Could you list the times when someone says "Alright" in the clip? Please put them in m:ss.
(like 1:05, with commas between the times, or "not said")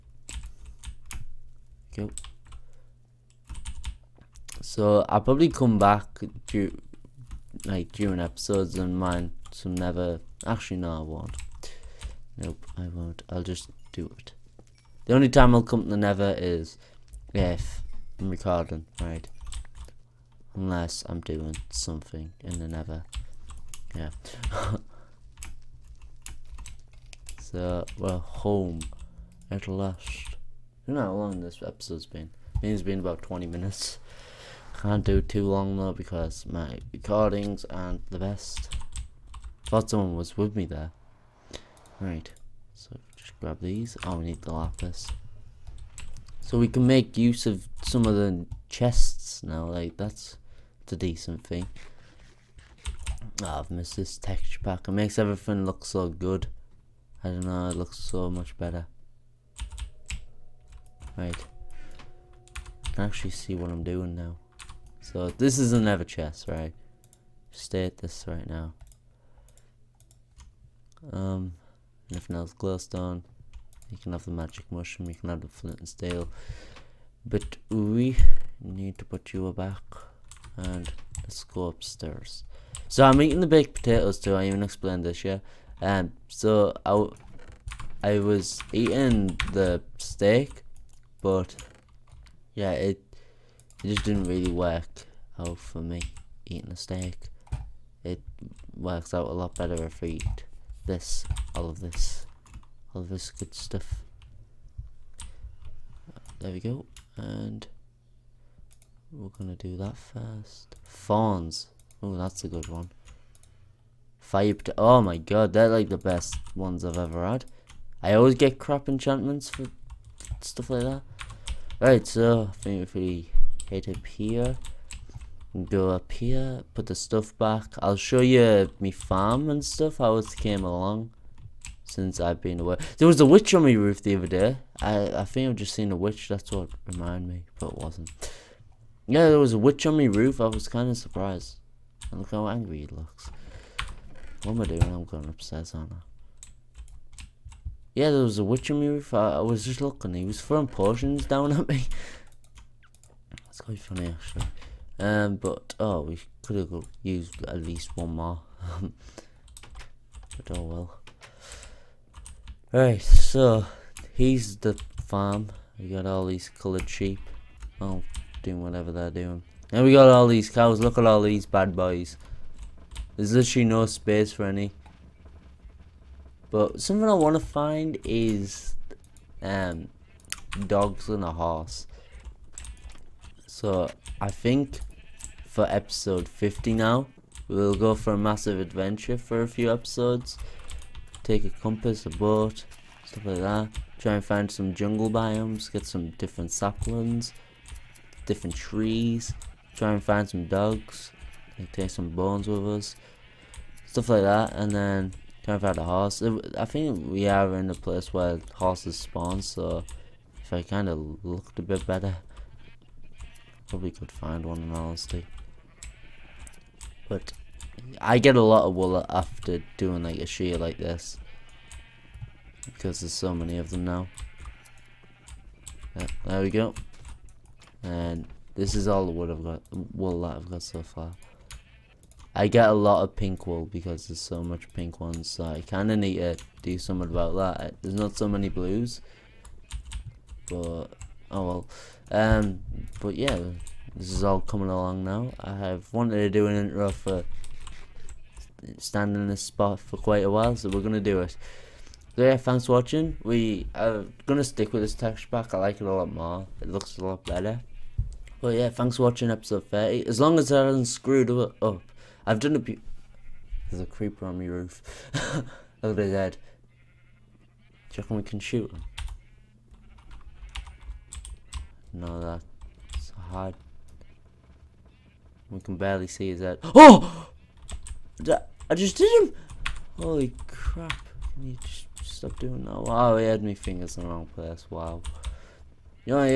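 2:42.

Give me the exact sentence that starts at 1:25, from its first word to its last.
Um, so I, I was eating the steak, but yeah, it it just didn't really work out for me eating a steak.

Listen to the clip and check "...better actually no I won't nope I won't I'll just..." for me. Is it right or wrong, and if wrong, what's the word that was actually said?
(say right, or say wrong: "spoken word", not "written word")
wrong: "nether", not "better".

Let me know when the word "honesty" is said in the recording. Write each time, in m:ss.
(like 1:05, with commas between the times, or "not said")
3:34.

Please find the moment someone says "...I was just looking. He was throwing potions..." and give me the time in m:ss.
2:29.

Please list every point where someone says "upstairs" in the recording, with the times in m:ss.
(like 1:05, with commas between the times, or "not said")
1:21, 2:25.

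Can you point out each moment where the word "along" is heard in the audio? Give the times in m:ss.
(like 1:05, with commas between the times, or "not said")
2:10, 4:04.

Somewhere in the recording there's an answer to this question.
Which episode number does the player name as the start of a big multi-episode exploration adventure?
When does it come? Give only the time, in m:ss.
3:05.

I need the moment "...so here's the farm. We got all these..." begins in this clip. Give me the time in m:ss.
2:43.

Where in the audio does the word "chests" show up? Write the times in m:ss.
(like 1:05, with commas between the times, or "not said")
0:48, 1:06.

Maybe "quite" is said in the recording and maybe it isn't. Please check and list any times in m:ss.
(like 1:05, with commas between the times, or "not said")
2:33, 4:09.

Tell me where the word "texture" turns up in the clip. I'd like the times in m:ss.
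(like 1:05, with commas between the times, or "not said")
0:54, 4:14.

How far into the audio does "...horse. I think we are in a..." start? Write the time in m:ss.
3:25.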